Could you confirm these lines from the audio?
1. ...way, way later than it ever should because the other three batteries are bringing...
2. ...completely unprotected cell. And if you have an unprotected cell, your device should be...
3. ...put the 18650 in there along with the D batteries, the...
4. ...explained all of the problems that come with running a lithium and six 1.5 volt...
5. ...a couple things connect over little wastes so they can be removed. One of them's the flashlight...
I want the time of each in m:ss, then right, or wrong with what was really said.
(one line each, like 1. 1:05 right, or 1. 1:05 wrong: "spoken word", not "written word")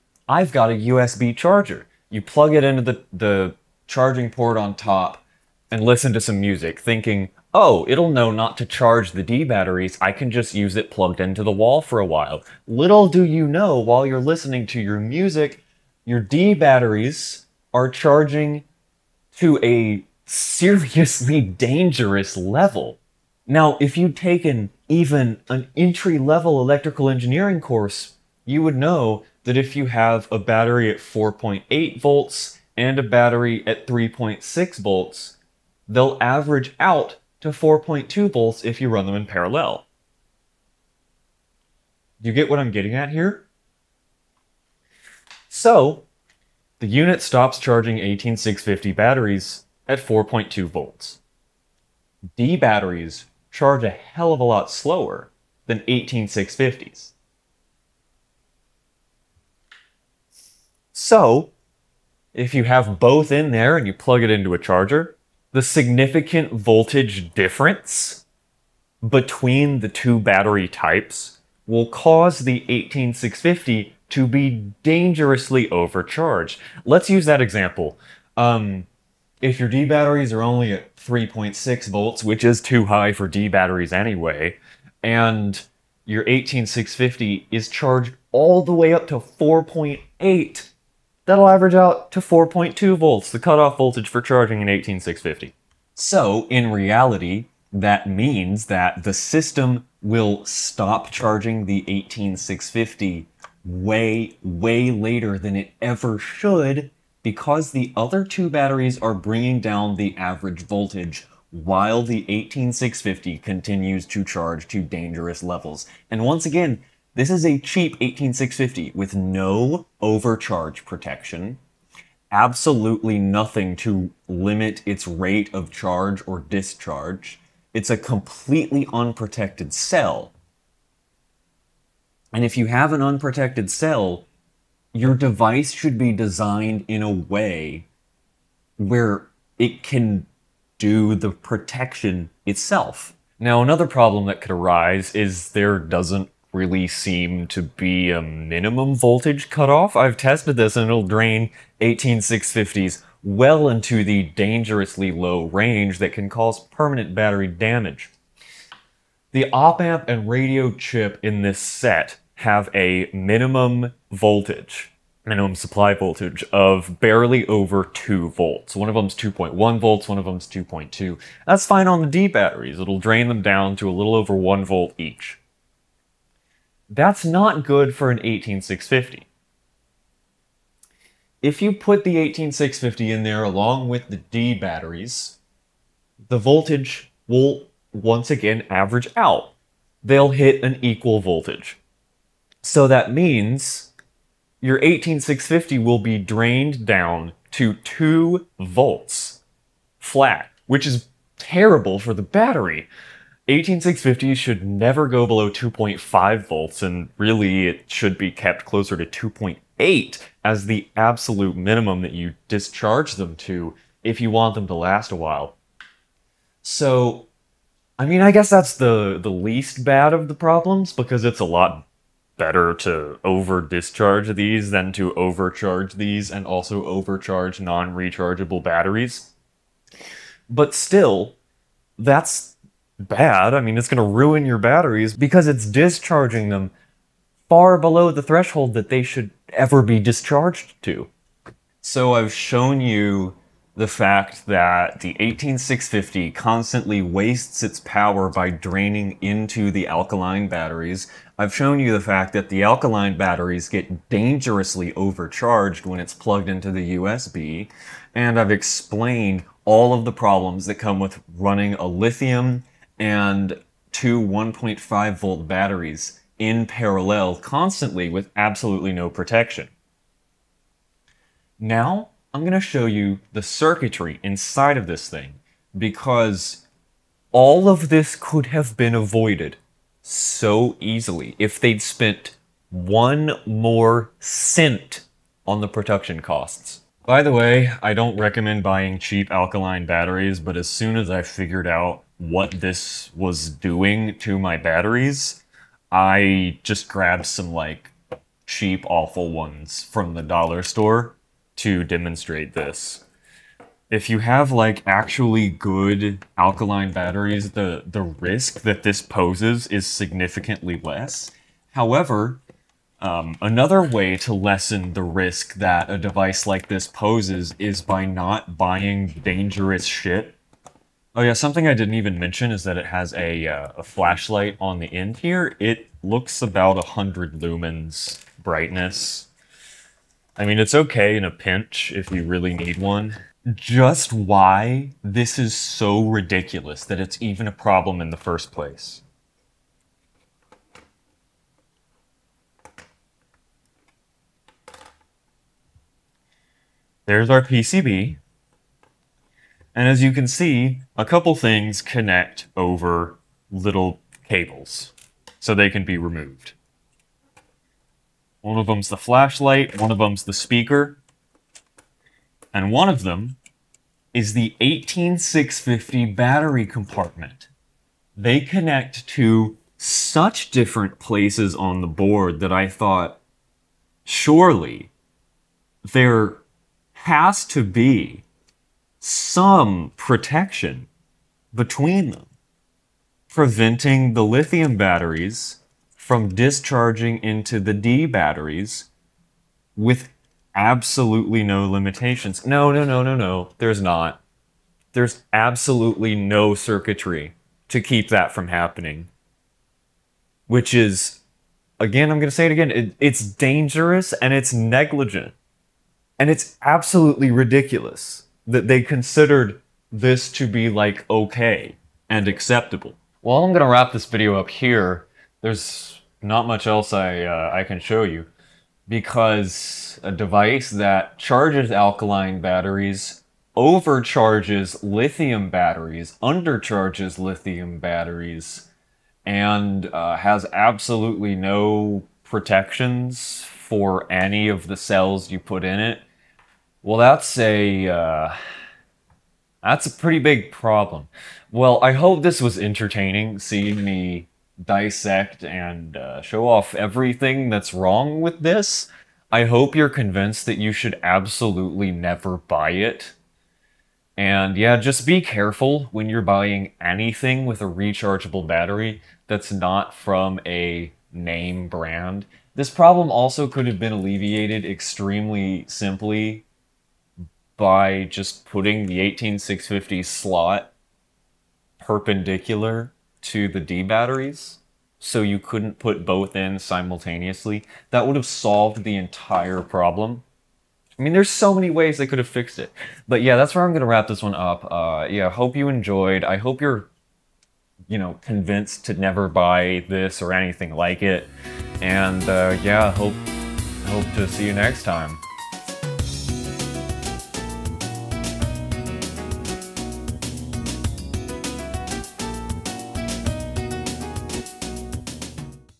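1. 1:43 wrong: "two", not "three"
2. 2:07 right
3. 3:01 right
4. 4:18 wrong: "two", not "six"
5. 5:50 wrong: "cables", not "wastes".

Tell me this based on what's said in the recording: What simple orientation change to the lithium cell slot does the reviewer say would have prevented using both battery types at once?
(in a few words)
perpendicular.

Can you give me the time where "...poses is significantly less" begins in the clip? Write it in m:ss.
5:09.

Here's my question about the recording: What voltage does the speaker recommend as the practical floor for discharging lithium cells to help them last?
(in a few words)
2.8.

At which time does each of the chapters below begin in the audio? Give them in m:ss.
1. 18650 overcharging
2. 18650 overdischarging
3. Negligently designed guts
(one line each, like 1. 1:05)
1. 0:23
2. 2:23
3. 4:02.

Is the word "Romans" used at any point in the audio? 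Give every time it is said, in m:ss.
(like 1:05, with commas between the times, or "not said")
not said.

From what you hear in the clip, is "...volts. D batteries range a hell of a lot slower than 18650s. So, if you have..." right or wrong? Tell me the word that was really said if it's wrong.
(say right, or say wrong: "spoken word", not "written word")
wrong: "charge", not "range".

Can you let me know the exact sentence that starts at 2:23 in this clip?
Now, another problem that could arise is there doesn't really seem to be a minimum voltage cutoff.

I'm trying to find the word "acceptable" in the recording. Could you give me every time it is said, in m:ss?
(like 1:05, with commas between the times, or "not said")
6:52.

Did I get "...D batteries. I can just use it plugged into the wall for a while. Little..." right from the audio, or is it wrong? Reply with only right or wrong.
right.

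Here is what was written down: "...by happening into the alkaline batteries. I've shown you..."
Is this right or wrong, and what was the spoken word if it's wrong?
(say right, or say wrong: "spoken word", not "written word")
wrong: "draining", not "happening".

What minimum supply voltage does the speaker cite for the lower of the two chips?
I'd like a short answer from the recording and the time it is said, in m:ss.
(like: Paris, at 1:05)
2.1 volts, at 2:49.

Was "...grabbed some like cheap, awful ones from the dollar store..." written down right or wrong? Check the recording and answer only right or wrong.
right.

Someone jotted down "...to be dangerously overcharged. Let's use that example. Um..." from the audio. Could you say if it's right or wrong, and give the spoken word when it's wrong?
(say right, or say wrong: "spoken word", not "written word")
right.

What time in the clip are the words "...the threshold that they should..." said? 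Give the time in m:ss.
3:58.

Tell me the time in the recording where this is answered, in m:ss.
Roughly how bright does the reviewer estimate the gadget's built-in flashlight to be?
5:26.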